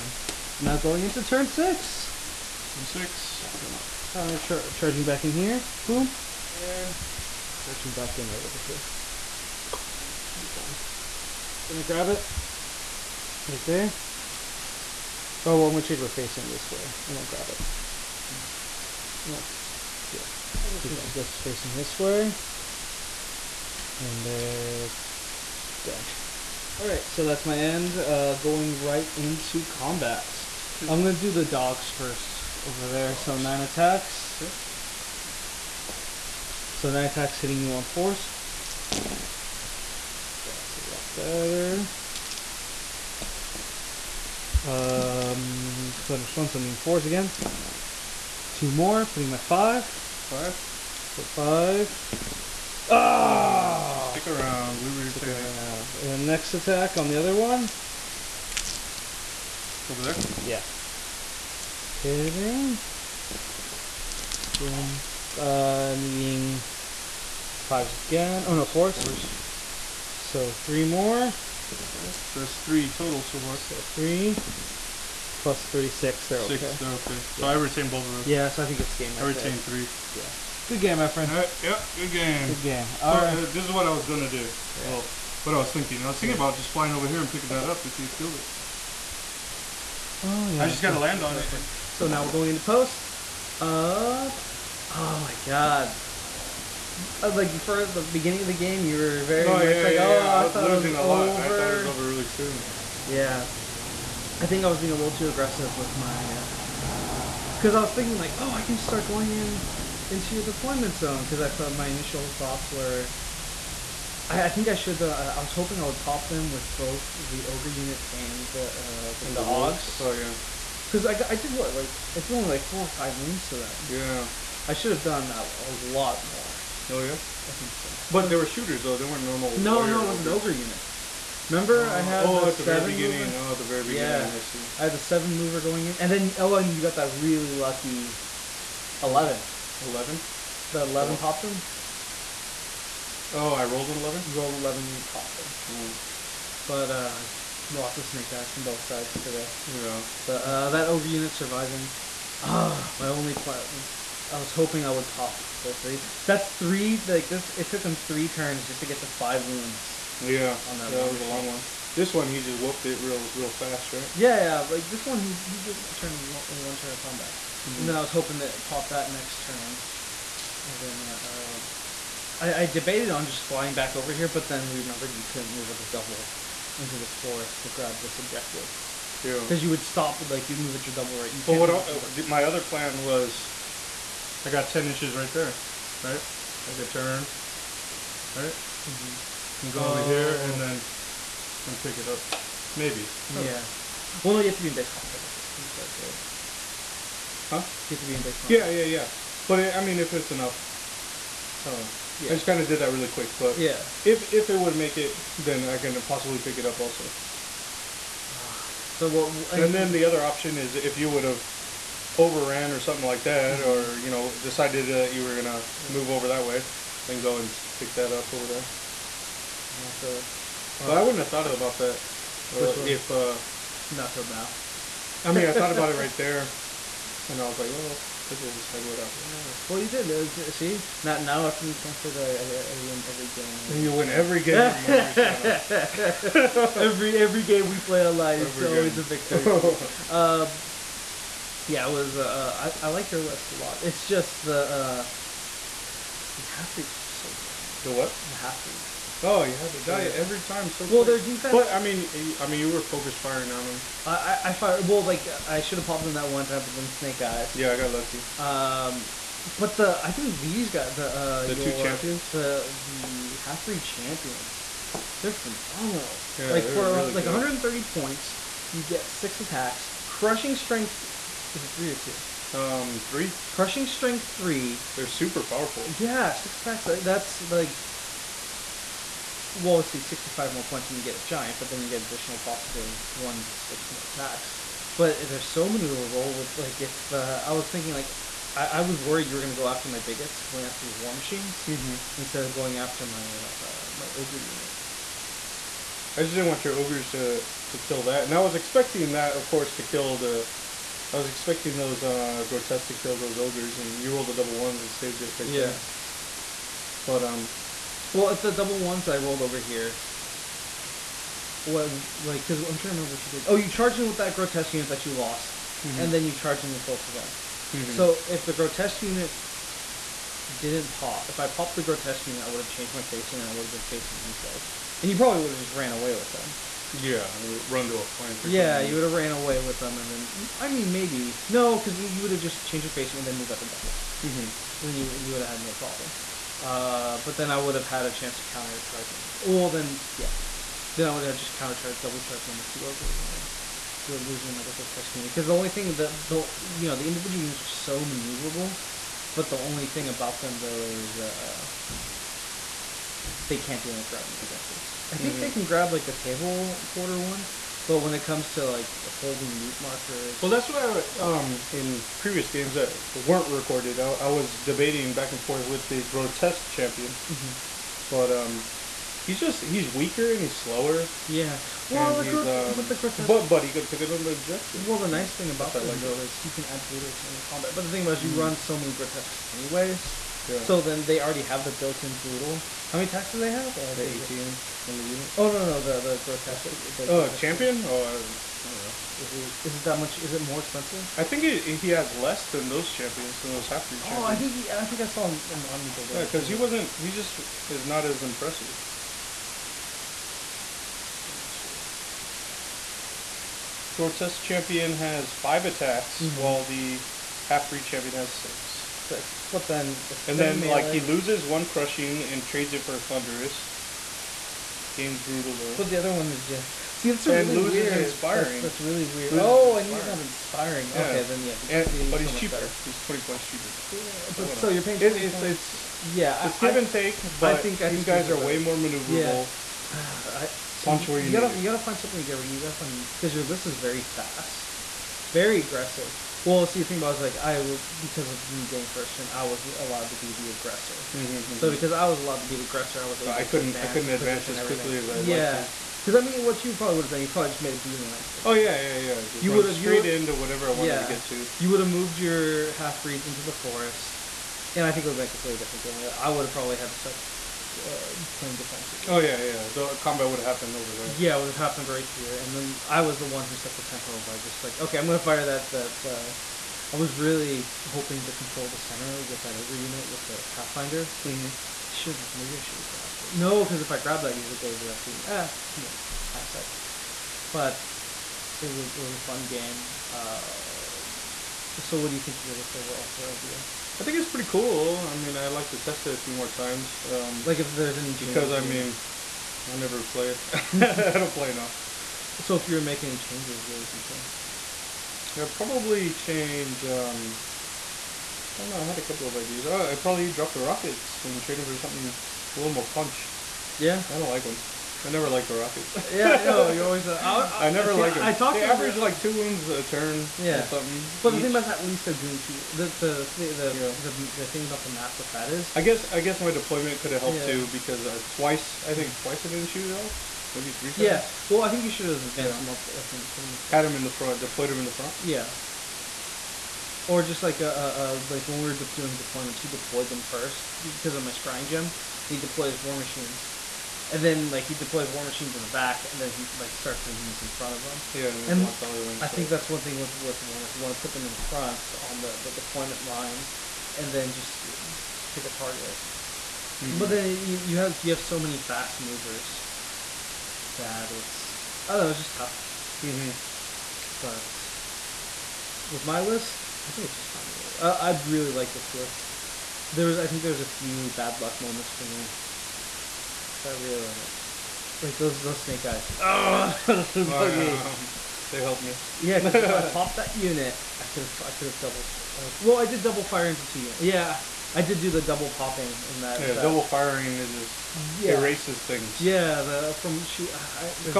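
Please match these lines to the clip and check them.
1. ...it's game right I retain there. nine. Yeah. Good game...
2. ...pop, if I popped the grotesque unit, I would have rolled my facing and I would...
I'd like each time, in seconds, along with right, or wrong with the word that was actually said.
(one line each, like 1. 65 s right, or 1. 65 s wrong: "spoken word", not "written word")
1. 78 s wrong: "three", not "nine"
2. 320 s wrong: "changed", not "rolled".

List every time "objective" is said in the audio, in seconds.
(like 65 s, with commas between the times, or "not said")
178 s, 354 s, 374 s.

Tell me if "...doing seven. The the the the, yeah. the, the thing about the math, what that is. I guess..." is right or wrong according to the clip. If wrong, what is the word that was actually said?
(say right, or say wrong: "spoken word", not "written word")
wrong: "two", not "seven".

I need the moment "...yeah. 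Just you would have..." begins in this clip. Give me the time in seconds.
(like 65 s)
449 s.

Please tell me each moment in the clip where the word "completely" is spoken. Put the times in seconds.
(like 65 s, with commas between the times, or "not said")
455 s.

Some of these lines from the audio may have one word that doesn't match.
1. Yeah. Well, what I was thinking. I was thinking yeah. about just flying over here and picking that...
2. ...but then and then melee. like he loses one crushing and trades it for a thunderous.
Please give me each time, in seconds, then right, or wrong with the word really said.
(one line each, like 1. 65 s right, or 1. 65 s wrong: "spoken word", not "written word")
1. 84 s right
2. 409 s right.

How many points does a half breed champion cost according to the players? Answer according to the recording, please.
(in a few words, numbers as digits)
130.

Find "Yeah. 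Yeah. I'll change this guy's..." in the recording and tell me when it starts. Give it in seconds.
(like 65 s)
19 s.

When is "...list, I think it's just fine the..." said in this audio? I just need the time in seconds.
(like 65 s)
556 s.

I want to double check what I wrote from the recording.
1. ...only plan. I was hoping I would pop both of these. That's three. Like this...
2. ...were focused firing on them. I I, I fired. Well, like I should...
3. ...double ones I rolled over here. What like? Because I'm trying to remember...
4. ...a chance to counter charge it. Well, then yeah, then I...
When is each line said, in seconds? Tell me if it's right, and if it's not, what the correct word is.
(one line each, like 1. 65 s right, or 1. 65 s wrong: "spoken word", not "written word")
1. 153 s right
2. 252 s right
3. 308 s right
4. 338 s right.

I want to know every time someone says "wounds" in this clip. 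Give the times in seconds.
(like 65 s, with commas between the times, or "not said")
123 s, 159 s, 509 s.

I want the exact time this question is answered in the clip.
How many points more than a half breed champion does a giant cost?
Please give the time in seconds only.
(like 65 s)
280 s.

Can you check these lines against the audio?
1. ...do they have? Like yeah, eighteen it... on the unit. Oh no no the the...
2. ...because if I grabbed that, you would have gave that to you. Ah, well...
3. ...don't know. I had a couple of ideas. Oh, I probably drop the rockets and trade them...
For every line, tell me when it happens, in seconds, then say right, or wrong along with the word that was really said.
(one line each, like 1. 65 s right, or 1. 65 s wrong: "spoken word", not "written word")
1. 383 s right
2. 473 s right
3. 498 s right.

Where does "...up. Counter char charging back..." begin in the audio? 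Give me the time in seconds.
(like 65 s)
3 s.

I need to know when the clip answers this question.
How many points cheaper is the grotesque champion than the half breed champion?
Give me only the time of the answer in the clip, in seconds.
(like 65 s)
422 s.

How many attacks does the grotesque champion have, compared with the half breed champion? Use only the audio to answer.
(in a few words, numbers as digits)
5.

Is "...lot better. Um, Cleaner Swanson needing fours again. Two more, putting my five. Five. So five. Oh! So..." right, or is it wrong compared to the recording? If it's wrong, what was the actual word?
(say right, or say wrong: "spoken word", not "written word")
right.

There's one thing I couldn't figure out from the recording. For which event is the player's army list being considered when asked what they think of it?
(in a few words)
LVO.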